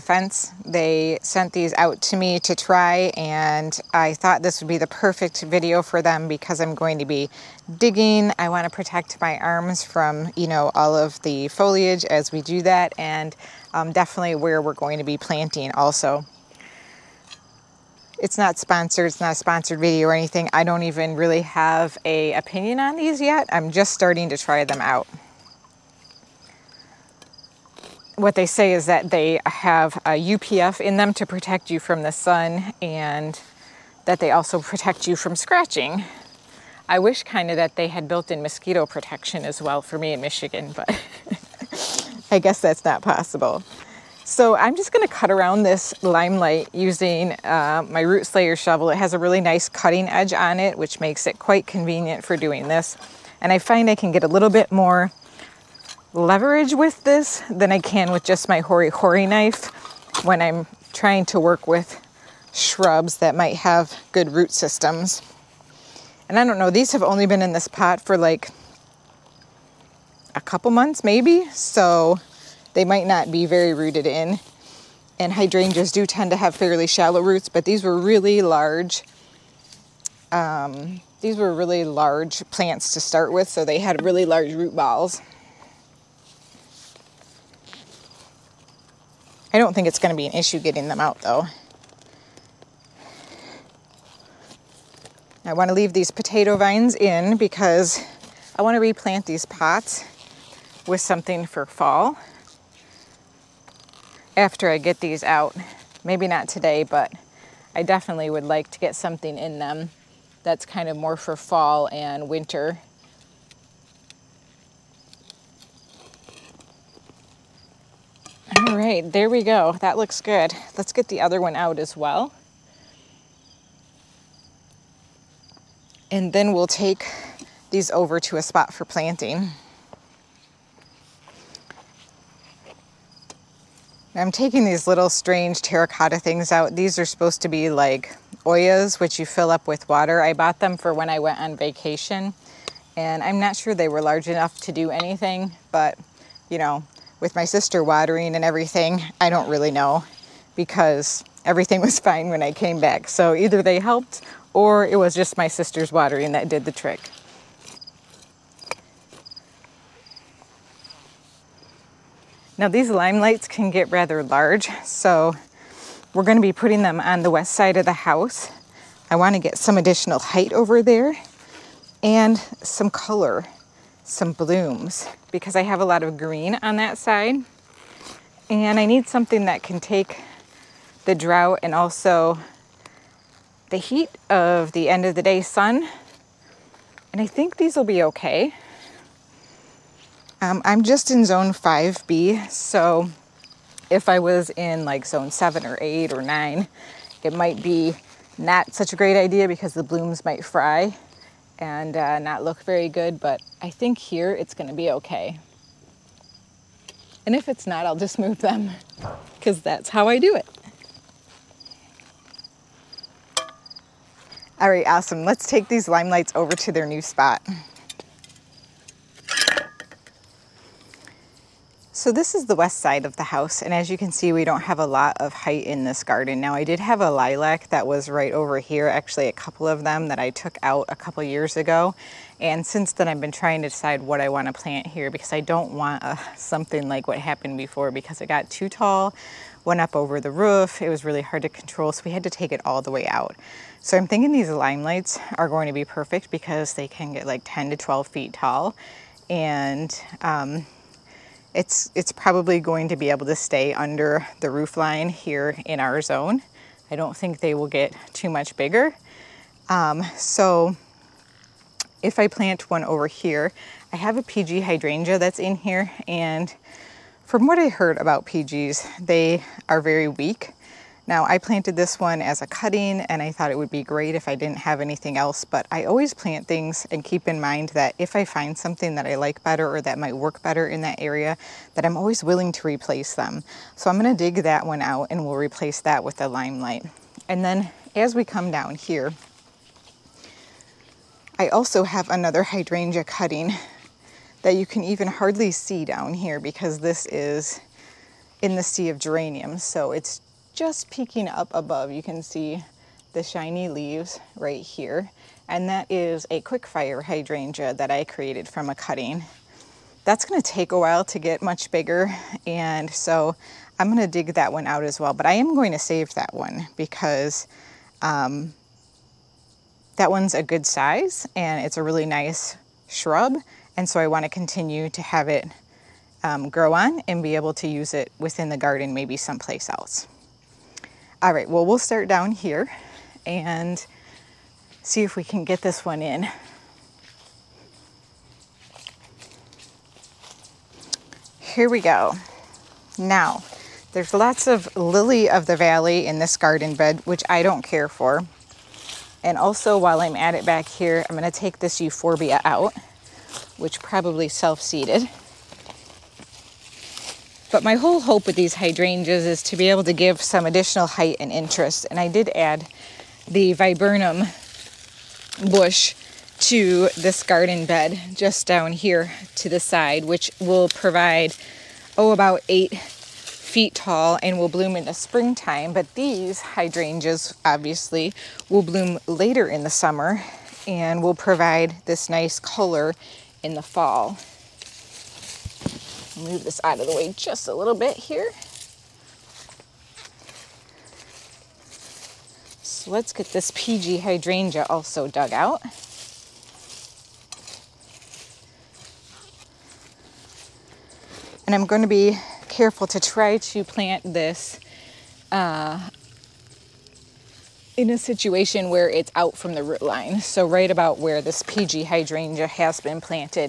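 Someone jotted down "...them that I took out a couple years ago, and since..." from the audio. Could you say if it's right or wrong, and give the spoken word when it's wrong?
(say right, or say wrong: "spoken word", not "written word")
right.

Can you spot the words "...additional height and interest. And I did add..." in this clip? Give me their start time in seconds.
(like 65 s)
360 s.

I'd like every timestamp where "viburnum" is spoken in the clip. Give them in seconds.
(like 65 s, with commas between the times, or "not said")
363 s.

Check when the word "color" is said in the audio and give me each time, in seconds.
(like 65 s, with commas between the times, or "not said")
172 s, 382 s.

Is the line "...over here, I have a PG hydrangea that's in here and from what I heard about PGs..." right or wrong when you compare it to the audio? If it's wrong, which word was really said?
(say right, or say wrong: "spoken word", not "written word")
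right.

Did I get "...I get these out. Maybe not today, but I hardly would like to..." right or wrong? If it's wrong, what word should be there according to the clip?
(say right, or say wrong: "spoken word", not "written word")
wrong: "definitely", not "hardly".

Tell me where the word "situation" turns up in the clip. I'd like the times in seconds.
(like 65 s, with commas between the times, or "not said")
407 s.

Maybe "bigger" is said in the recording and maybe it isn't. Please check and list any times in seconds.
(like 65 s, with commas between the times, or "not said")
258 s, 311 s.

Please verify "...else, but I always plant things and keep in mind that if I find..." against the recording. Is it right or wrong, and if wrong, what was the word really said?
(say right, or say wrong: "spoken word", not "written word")
right.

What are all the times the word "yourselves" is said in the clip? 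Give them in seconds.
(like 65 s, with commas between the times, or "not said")
not said.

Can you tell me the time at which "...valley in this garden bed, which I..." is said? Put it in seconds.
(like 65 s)
345 s.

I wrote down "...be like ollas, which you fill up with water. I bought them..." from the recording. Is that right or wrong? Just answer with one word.
right.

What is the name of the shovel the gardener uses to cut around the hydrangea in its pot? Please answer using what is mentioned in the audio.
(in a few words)
Root Slayer.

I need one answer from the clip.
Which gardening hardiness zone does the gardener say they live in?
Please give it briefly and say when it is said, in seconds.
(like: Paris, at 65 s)
5B, at 191 s.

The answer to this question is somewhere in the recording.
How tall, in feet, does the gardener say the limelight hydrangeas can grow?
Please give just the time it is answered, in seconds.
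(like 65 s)
247 s.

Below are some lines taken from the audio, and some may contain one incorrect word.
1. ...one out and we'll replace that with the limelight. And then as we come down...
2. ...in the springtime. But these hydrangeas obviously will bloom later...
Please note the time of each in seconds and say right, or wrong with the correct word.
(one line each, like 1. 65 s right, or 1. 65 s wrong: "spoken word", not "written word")
1. 284 s right
2. 374 s right.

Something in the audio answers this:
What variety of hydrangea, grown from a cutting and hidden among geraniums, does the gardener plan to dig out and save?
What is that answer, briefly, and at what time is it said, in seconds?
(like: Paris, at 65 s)
Quickfire, at 306 s.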